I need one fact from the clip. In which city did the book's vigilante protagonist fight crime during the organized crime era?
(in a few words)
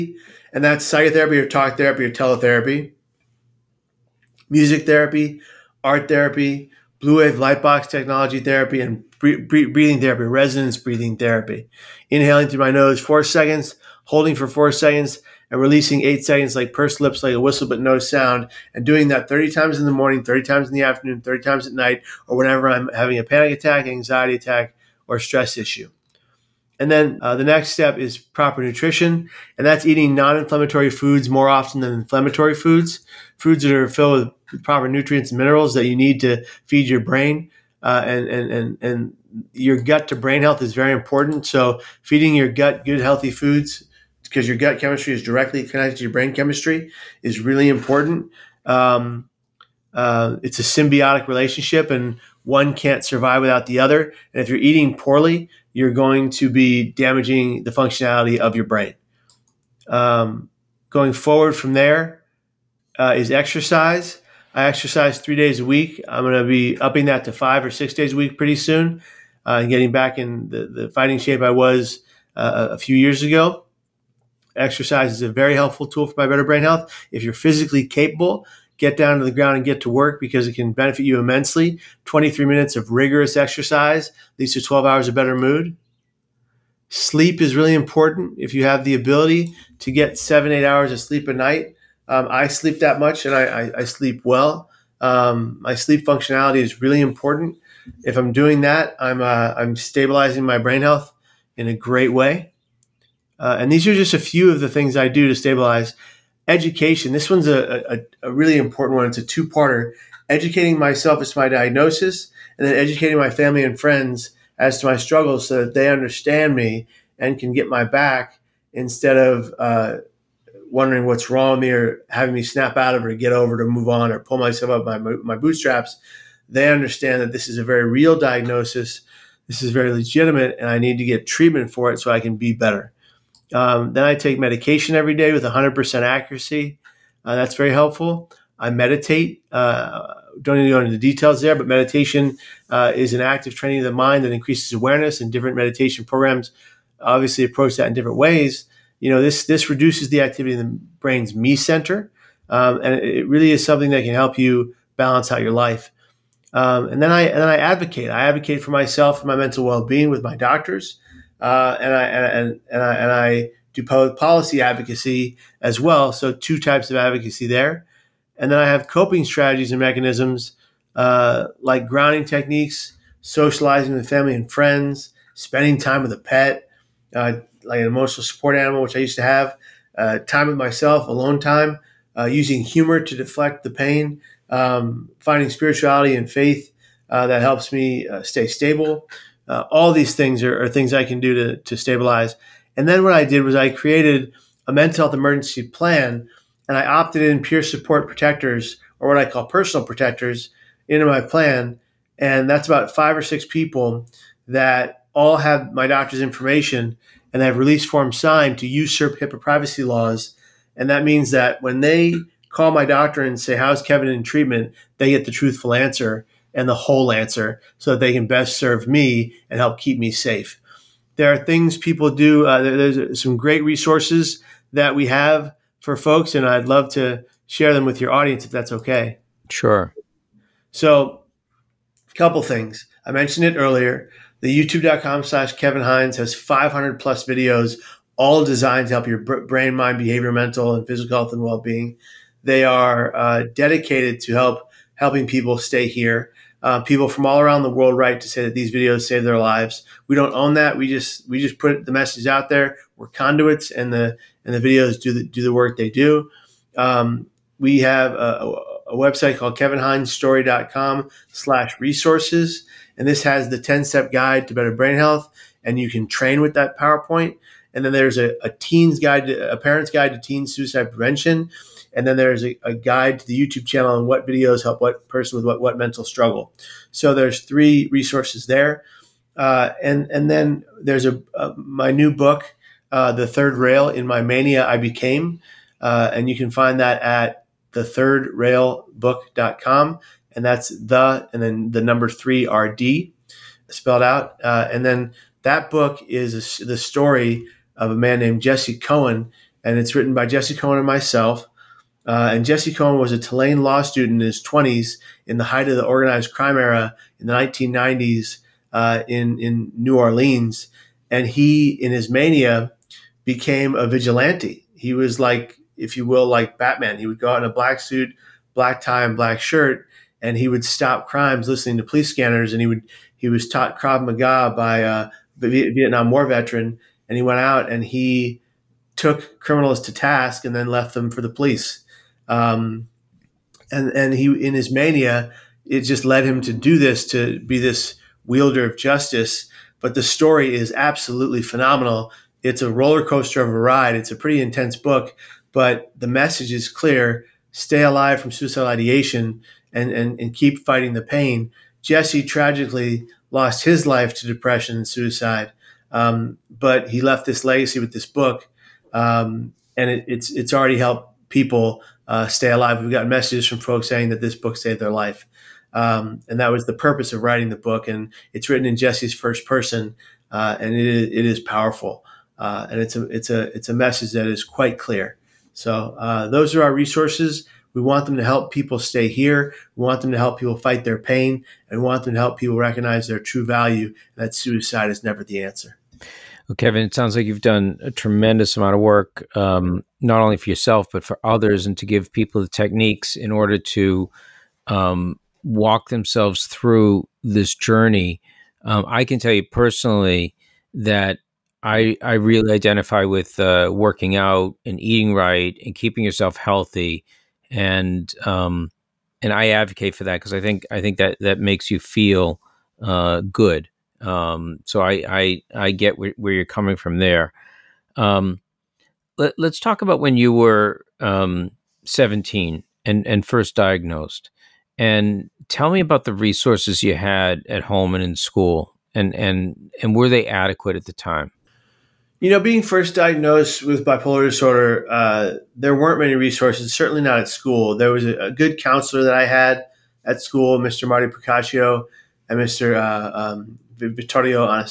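New Orleans.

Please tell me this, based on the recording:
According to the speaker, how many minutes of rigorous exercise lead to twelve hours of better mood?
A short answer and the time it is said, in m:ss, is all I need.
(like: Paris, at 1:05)
23, at 1:22.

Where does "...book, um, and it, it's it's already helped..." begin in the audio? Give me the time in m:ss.
5:58.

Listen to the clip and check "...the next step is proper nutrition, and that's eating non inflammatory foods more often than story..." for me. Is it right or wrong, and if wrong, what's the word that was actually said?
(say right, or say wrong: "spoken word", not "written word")
wrong: "inflammatory", not "story".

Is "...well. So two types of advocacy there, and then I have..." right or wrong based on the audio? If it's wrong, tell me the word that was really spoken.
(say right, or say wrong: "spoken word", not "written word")
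right.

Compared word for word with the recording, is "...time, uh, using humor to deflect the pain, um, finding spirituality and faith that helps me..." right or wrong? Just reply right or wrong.
right.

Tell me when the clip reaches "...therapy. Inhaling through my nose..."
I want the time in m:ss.
0:11.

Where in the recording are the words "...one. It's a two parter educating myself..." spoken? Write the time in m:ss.
1:48.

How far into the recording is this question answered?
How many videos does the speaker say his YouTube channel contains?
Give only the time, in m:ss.
3:56.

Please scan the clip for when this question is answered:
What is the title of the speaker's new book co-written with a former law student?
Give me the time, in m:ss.
4:43.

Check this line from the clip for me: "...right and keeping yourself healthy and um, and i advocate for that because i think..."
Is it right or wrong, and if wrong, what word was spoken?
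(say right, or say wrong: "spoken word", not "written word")
right.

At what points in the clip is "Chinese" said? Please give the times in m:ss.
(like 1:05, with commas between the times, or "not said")
not said.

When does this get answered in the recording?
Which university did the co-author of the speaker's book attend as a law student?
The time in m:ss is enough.
5:03.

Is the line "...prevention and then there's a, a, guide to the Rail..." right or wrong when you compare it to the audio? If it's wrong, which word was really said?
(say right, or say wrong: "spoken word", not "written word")
wrong: "YouTube", not "Rail".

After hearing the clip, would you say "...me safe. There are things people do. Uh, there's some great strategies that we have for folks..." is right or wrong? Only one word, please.
wrong.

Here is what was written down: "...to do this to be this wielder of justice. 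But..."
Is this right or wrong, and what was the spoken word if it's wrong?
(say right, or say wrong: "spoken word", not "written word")
right.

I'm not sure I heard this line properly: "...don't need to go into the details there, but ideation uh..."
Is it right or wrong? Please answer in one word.
wrong.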